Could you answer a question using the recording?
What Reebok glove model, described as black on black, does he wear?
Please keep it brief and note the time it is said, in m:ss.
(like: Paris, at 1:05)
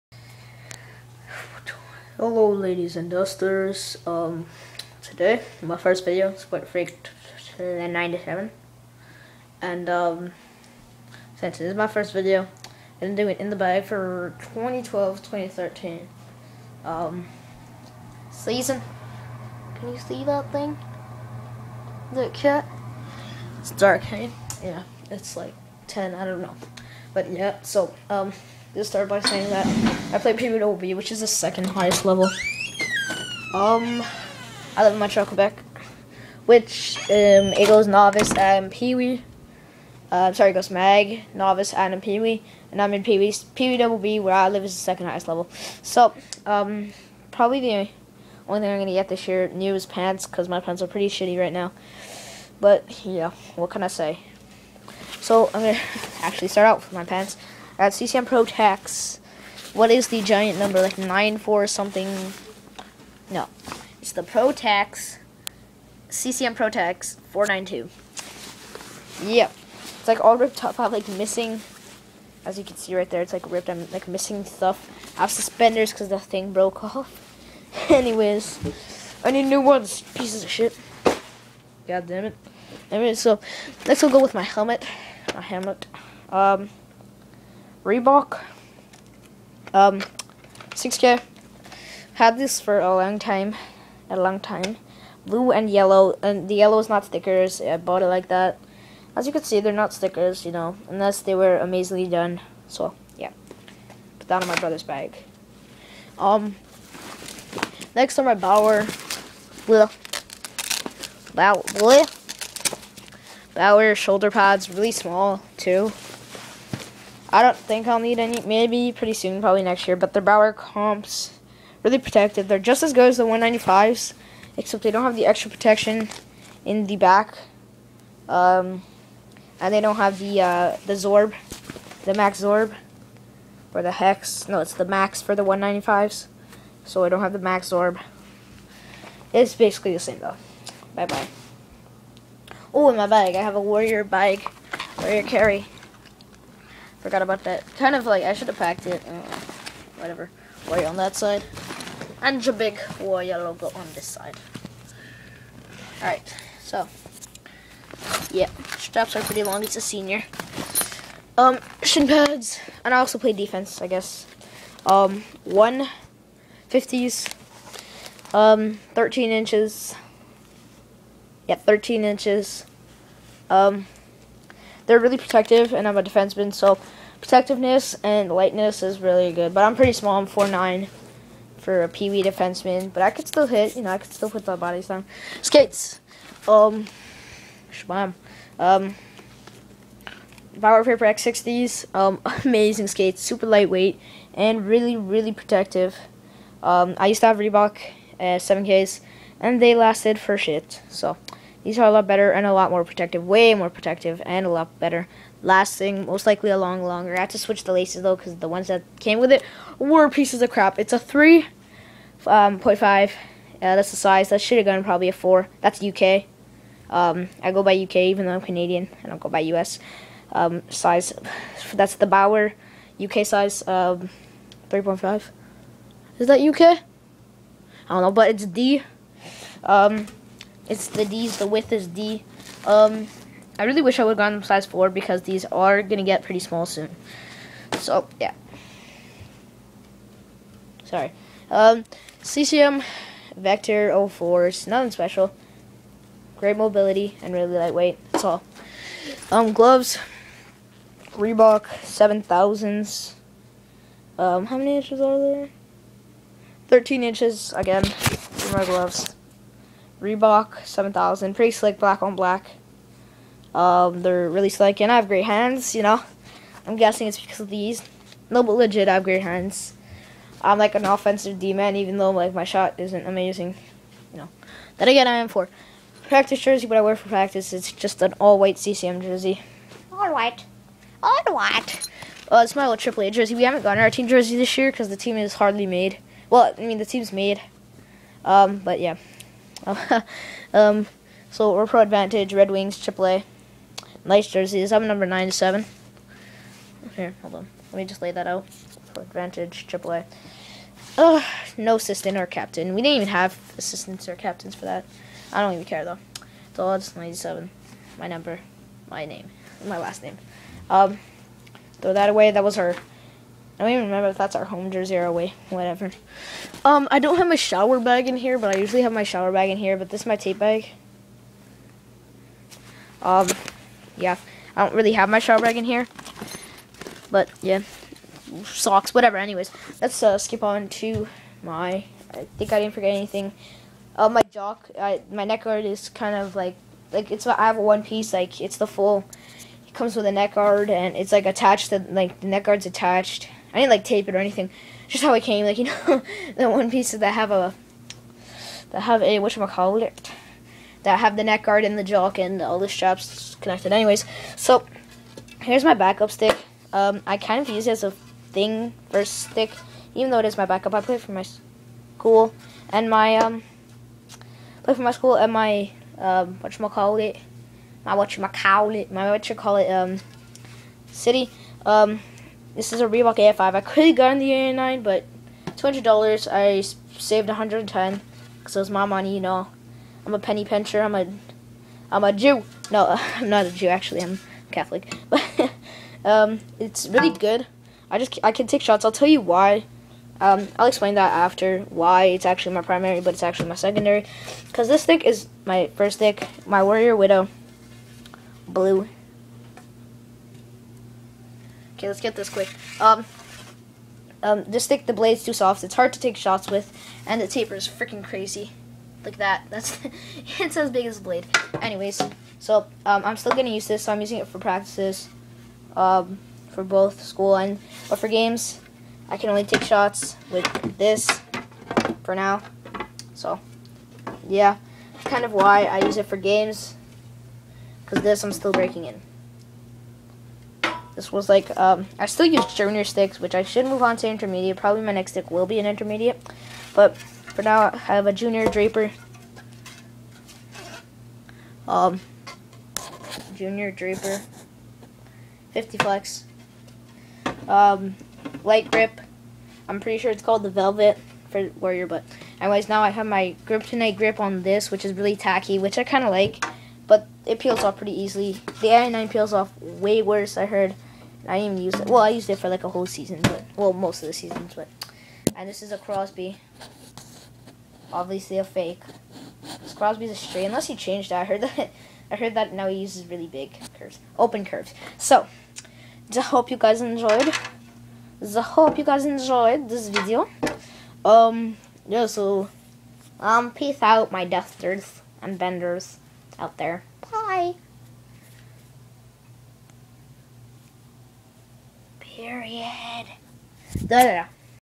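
Reebok 7000, at 4:11.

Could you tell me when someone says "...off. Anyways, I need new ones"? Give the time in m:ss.
1:16.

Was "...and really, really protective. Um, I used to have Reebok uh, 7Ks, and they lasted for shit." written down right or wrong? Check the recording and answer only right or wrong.
right.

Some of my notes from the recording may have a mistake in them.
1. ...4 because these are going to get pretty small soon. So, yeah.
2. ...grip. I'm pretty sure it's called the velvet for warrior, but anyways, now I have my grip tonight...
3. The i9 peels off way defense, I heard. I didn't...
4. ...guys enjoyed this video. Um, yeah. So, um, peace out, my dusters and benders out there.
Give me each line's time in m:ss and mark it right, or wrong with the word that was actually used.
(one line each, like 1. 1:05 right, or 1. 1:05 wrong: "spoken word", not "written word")
1. 3:54 right
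2. 7:28 right
3. 7:38 wrong: "worse", not "defense"
4. 7:58 right.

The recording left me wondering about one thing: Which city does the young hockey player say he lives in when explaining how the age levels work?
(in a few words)
Montreal.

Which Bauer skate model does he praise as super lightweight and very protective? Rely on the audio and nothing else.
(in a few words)
Vapor X60.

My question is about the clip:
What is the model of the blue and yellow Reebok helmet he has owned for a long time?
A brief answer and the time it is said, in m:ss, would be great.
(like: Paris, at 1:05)
6K, at 1:30.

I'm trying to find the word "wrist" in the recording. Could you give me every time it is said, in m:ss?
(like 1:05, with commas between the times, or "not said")
not said.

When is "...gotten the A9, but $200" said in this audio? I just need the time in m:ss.
6:13.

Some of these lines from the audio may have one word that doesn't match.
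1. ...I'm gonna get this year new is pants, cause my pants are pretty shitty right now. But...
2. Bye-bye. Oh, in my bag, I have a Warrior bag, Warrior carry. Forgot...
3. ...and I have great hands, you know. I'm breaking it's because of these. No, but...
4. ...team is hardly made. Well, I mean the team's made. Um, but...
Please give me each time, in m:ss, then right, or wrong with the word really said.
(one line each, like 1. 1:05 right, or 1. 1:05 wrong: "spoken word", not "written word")
1. 0:48 right
2. 2:20 right
3. 4:24 wrong: "guessing", not "breaking"
4. 4:44 right.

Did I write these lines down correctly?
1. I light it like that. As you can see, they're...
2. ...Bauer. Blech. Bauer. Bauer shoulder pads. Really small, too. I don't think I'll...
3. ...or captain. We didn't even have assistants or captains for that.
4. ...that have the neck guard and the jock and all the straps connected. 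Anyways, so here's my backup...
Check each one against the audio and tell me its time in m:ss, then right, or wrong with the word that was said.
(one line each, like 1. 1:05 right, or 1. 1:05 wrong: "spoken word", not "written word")
1. 1:37 wrong: "bought", not "light"
2. 1:48 right
3. 5:02 right
4. 5:50 right.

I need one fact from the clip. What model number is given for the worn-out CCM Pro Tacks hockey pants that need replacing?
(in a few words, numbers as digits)
492.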